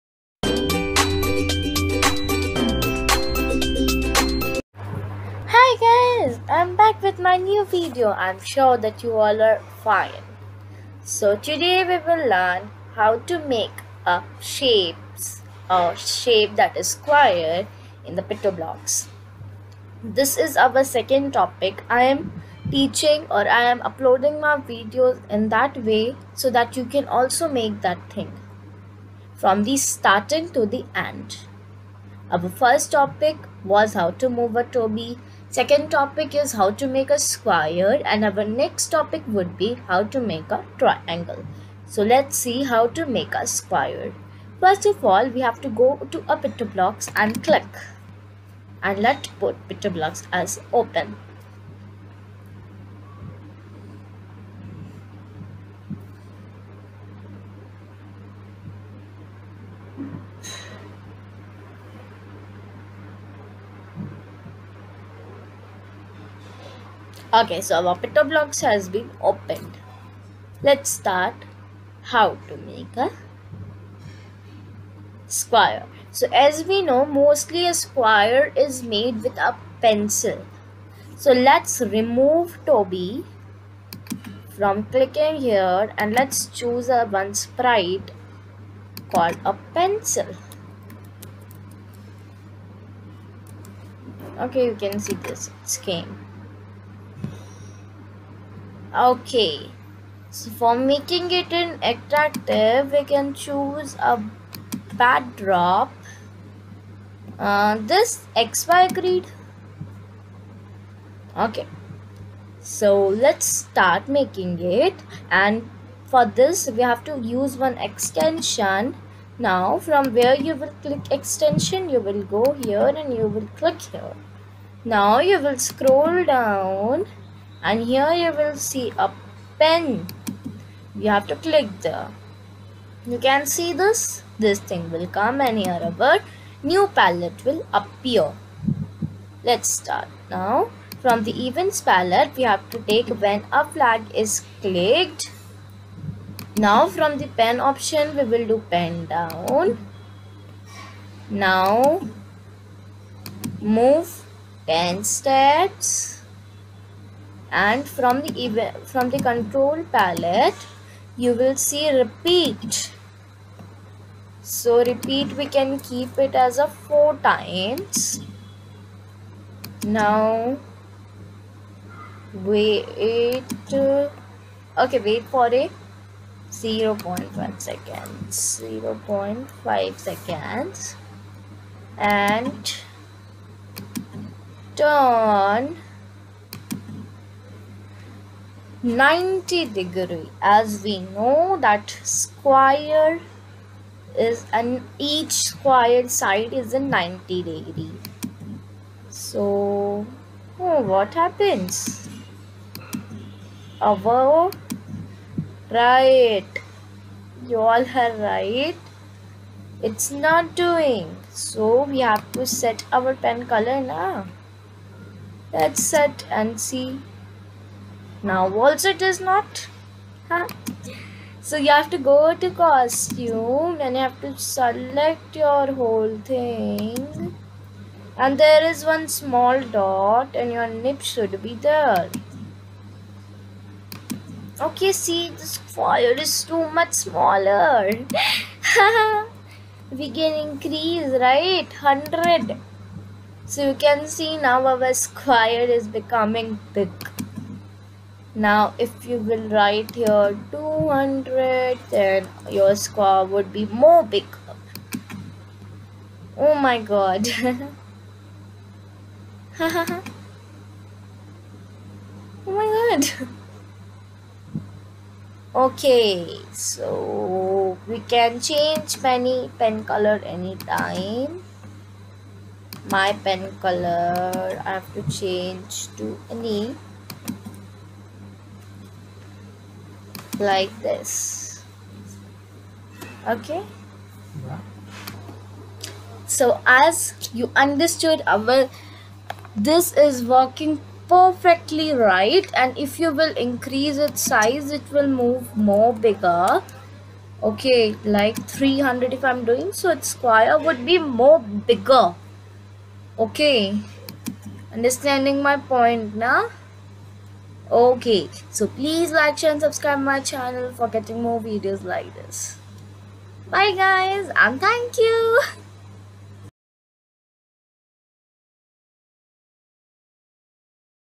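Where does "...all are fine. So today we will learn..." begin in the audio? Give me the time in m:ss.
0:09.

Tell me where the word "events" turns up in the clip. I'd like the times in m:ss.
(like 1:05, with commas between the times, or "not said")
2:21, 2:38.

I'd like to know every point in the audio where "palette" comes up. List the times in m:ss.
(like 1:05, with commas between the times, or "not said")
2:16, 2:21, 2:39.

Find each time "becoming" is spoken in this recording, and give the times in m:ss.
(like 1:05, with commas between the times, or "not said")
4:05.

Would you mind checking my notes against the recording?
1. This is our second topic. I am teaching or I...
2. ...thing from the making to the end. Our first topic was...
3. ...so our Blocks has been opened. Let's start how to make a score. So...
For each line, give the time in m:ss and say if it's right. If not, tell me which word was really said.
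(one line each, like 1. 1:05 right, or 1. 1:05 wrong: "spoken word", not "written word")
1. 0:20 right
2. 0:28 wrong: "starting", not "making"
3. 1:07 wrong: "square", not "score".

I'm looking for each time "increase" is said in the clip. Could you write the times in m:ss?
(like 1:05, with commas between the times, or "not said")
4:00, 4:53.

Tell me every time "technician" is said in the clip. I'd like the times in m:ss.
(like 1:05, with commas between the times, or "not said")
not said.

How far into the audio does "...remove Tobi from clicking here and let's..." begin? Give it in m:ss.
1:21.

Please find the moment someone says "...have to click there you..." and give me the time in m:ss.
2:11.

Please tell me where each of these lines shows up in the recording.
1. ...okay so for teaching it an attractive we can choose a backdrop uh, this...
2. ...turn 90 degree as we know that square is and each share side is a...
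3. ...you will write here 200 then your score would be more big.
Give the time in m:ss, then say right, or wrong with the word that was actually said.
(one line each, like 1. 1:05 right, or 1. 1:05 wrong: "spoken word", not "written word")
1. 1:38 wrong: "making", not "teaching"
2. 3:04 wrong: "square", not "share"
3. 4:09 right.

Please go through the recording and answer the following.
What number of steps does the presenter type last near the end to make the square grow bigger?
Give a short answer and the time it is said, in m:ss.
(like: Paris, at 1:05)
300, at 4:58.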